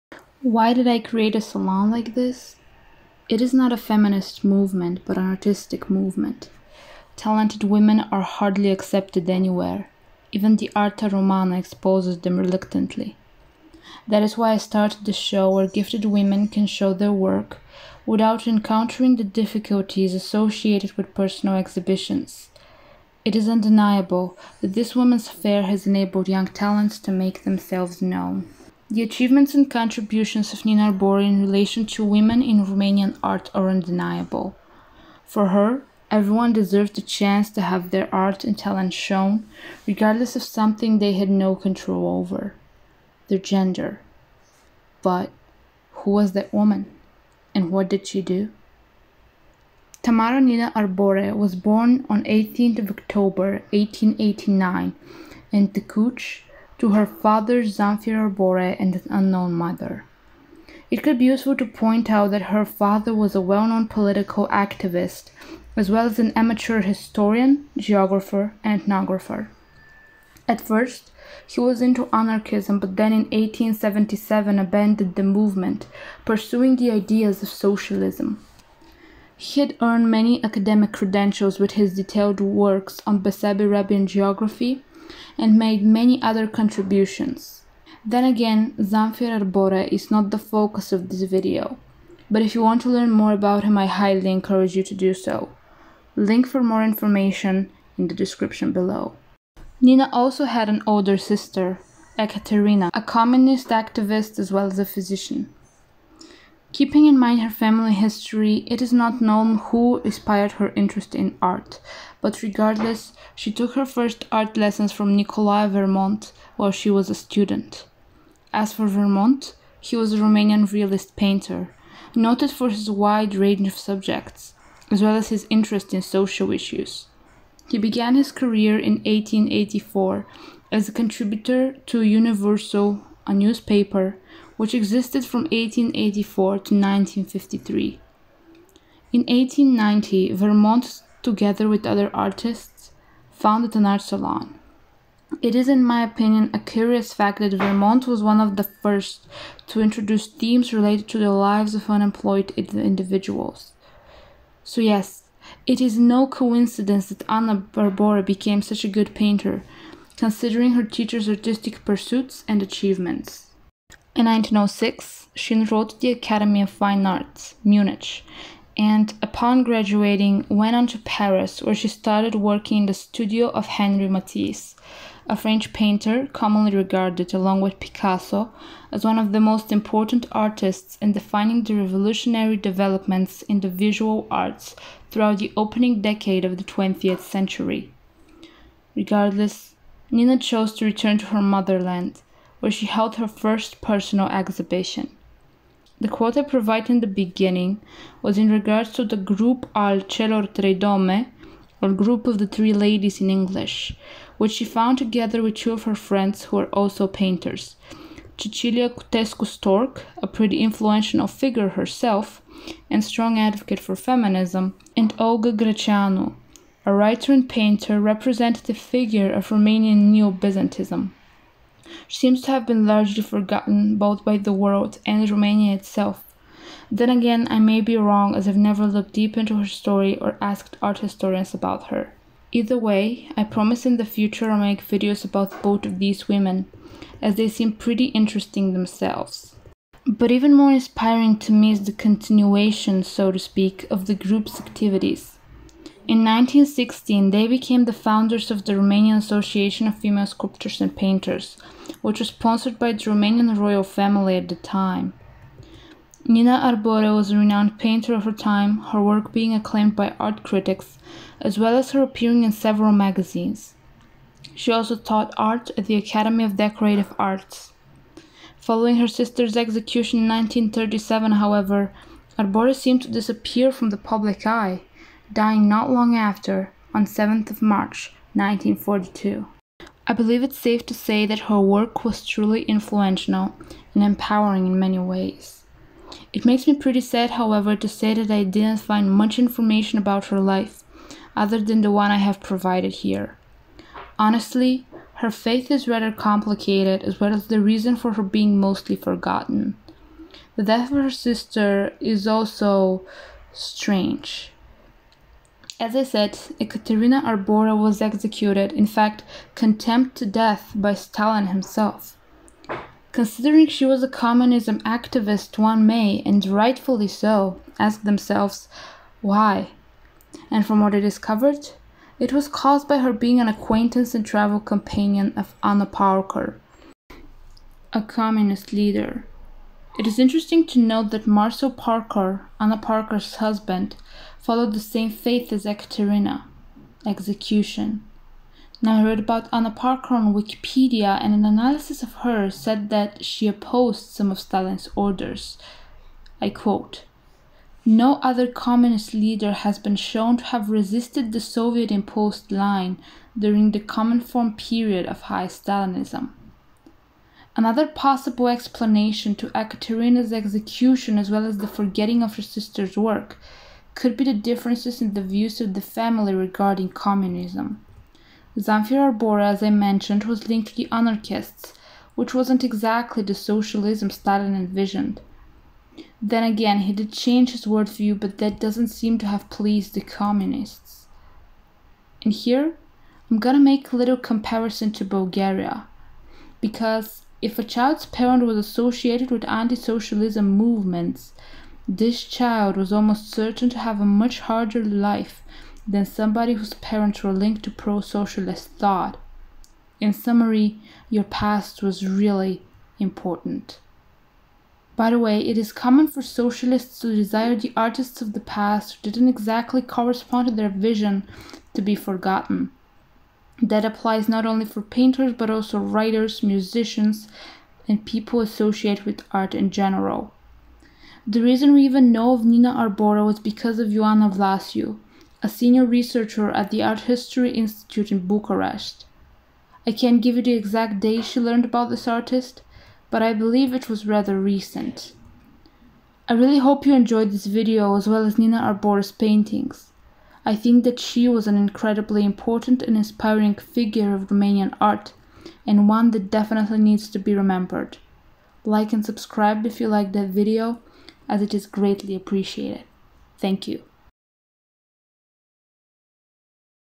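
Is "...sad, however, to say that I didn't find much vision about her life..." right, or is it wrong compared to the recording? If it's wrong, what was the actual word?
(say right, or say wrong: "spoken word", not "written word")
wrong: "information", not "vision".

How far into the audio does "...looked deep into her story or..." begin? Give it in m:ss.
3:48.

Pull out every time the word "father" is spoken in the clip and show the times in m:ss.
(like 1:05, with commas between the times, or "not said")
0:57, 1:02.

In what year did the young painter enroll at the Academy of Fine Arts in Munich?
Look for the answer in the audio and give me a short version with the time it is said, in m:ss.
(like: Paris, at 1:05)
1906, at 2:44.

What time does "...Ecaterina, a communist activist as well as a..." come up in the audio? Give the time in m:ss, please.
1:42.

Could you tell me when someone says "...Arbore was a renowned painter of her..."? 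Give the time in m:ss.
4:16.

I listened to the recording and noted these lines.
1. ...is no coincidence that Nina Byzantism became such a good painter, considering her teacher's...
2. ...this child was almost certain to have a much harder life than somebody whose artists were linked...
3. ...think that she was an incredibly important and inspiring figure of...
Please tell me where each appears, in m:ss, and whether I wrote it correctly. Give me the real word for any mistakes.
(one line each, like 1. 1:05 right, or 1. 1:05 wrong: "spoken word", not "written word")
1. 2:35 wrong: "Arbore", not "Byzantism"
2. 6:31 wrong: "parents", not "artists"
3. 7:20 right.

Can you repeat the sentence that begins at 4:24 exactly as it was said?
She also taught art at the Academy of Decorative Arts.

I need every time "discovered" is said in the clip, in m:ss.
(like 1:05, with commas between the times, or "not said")
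5:20.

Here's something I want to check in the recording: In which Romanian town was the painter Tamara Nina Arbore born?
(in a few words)
Tecuci.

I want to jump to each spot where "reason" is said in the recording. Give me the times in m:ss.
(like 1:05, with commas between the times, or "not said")
4:57, 7:01.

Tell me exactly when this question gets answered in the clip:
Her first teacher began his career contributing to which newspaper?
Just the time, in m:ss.
2:12.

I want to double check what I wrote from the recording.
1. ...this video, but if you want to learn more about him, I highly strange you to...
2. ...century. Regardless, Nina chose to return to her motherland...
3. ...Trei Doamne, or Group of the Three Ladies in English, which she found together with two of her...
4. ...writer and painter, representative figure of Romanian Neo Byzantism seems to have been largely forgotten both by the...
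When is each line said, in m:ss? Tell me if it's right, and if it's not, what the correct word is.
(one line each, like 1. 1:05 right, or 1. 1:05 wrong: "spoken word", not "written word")
1. 1:31 wrong: "encourage", not "strange"
2. 3:07 right
3. 3:20 right
4. 3:36 right.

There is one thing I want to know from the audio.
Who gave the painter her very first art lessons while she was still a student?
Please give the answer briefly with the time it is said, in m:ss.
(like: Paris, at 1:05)
Nicolae Vermont, at 1:55.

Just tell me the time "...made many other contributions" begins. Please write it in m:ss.
1:25.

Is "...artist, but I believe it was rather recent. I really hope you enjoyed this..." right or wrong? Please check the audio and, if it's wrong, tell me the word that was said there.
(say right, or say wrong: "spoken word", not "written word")
right.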